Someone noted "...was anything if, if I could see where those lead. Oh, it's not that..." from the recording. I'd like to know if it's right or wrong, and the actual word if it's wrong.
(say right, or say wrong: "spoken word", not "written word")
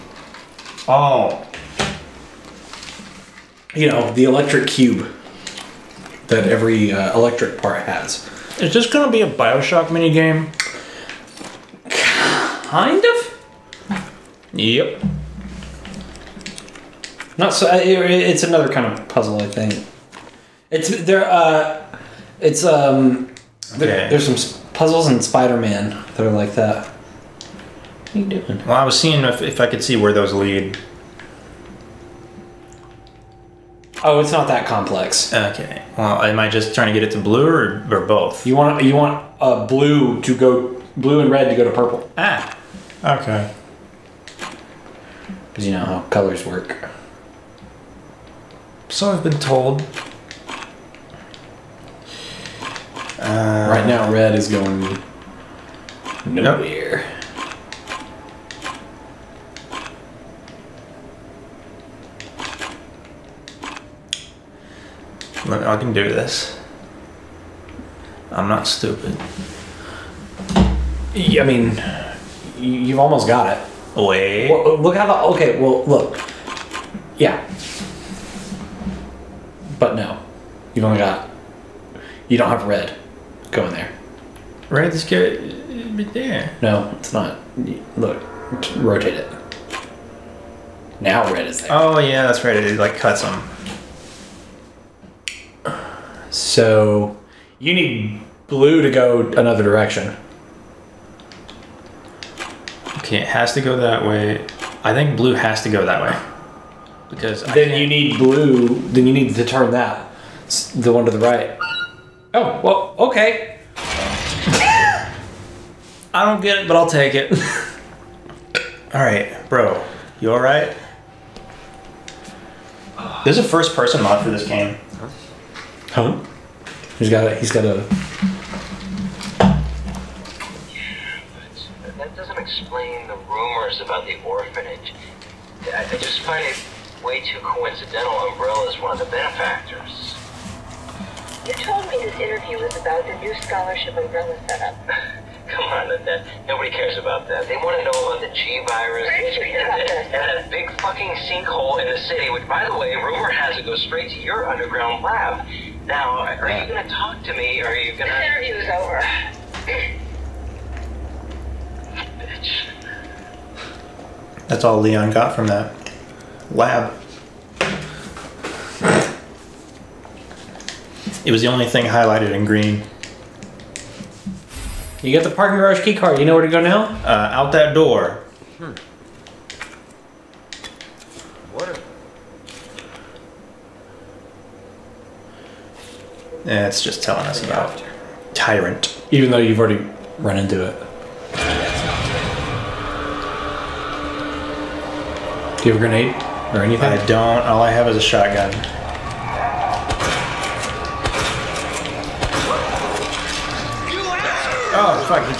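wrong: "seeing", not "anything".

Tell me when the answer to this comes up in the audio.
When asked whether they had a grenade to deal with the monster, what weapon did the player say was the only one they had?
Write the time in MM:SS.
03:18.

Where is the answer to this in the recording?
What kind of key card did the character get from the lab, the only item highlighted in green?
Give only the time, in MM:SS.
02:55.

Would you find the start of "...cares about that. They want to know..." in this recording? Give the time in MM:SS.
02:26.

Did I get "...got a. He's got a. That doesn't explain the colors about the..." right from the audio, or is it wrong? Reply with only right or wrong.
wrong.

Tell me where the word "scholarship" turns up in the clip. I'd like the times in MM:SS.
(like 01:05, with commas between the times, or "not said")
02:23.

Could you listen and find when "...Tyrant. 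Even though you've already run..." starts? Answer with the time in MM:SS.
03:08.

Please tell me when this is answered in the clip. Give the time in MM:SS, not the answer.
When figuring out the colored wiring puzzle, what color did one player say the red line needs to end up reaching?
00:41.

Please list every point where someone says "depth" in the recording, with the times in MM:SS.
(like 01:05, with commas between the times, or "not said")
not said.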